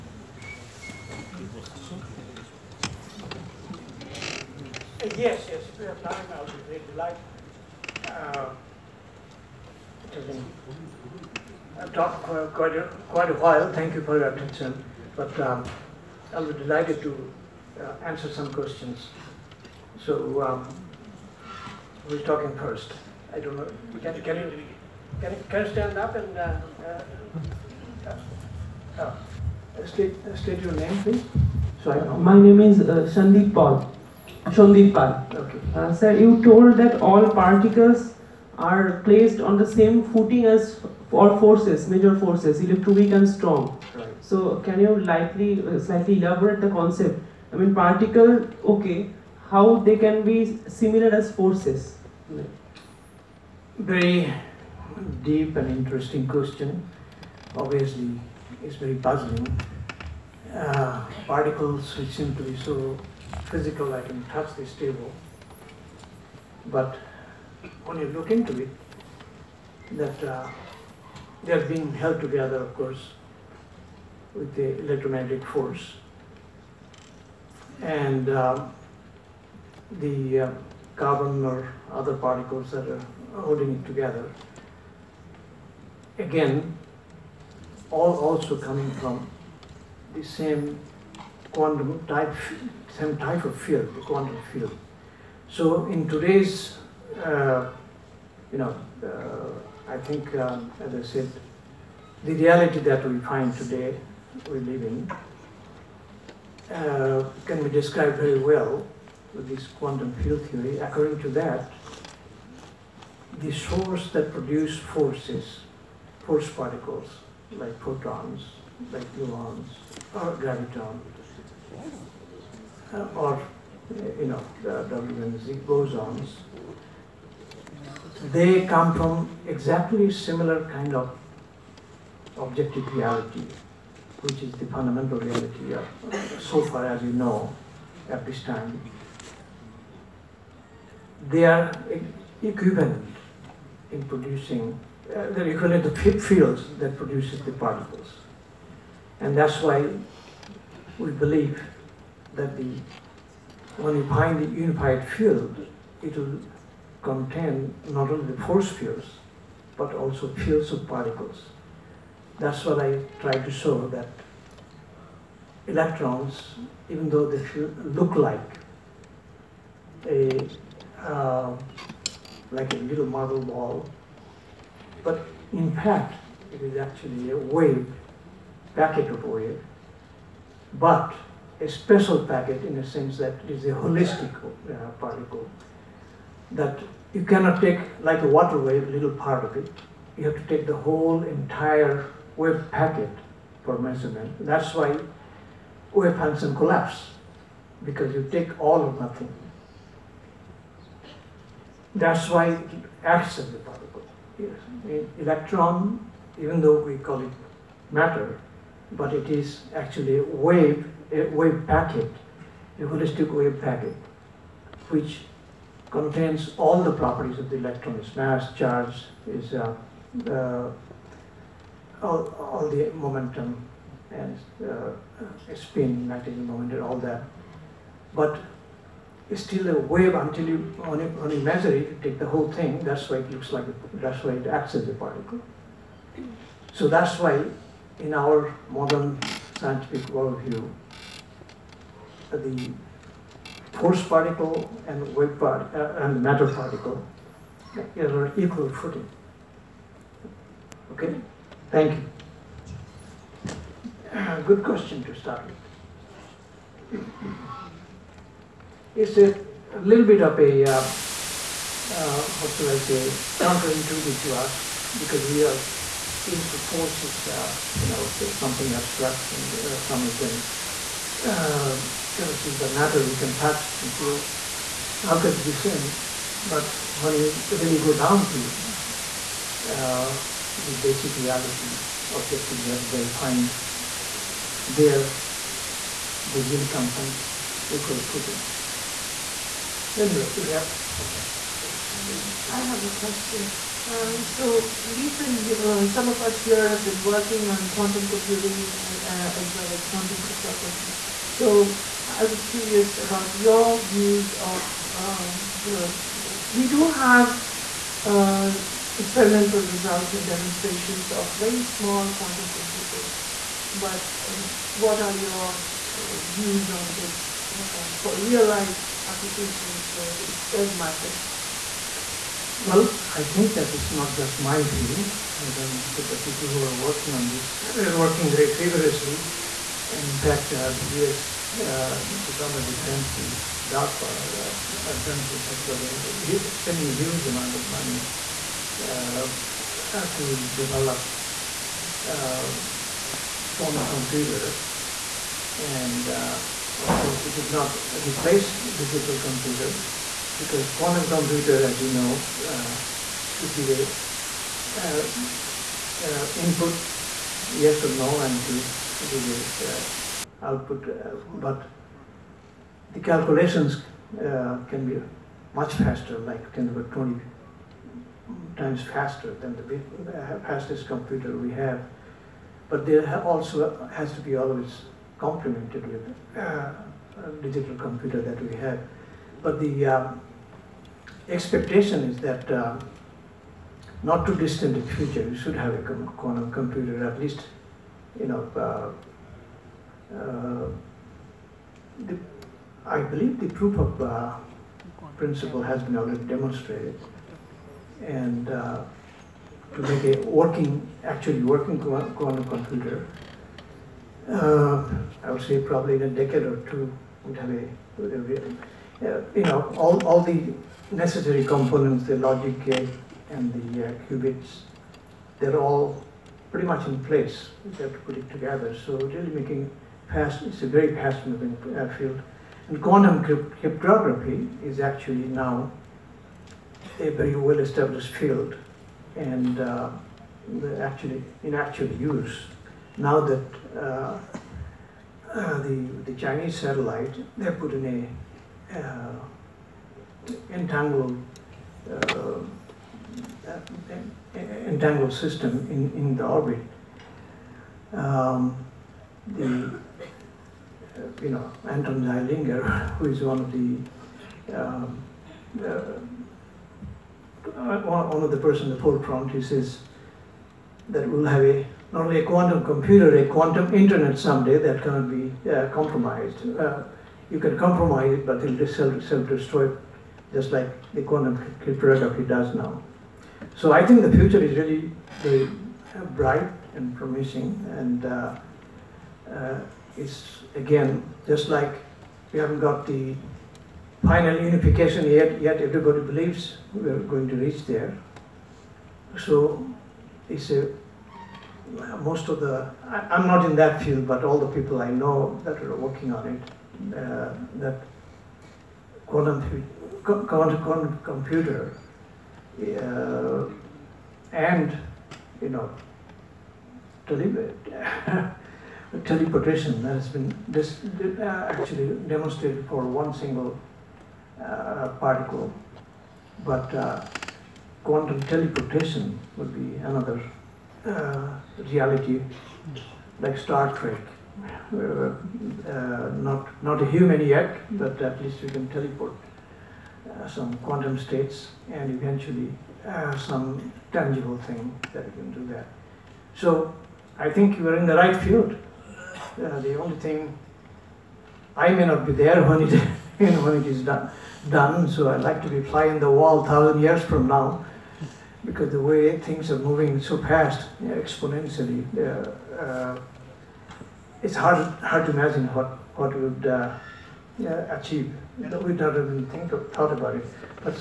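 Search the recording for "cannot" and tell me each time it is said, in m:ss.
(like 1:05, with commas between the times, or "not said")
3:07, 7:44.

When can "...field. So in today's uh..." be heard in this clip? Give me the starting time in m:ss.
1:34.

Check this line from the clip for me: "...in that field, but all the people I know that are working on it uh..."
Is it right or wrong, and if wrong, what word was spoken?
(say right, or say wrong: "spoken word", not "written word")
right.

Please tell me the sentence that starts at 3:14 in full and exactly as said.
That's why wave function collapse because you take all or nothing.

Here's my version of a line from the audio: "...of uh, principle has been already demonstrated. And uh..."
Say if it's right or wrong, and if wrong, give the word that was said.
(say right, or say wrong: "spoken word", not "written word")
right.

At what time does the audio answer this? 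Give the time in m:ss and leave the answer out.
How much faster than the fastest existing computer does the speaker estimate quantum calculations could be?
6:06.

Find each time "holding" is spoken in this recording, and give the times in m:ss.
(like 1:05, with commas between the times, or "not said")
1:23.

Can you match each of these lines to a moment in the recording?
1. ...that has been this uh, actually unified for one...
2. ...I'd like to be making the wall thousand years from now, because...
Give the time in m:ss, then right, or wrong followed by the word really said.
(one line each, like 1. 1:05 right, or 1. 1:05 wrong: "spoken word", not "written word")
1. 8:29 wrong: "demonstrated", not "unified"
2. 9:05 wrong: "flying", not "making".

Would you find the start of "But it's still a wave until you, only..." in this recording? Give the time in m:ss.
3:48.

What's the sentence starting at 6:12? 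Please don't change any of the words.
But there also has to be always complemented with digital computer that we have.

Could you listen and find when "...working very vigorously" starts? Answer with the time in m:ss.
5:27.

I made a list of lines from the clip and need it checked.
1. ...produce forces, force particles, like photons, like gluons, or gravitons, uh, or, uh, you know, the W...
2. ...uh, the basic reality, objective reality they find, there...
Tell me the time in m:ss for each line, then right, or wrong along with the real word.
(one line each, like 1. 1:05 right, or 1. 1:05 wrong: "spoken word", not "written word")
1. 1:54 right
2. 4:39 right.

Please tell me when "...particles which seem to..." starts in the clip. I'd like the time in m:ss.
1:01.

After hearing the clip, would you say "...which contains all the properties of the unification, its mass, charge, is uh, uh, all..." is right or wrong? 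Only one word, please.
wrong.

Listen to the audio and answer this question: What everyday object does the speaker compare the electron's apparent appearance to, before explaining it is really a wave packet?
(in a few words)
a little marble ball.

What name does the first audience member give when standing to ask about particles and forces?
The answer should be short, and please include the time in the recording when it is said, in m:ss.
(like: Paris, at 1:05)
Sandeep Paul, at 0:32.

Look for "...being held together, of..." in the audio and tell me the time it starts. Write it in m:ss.
1:11.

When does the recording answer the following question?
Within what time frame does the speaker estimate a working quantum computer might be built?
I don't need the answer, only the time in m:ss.
6:46.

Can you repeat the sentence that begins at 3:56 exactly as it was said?
So that's why in our modern scientific worldview, the force particle and wave part, uh, and matter particle is on equal footing.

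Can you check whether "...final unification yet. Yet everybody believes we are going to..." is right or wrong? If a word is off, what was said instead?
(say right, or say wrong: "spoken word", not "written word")
right.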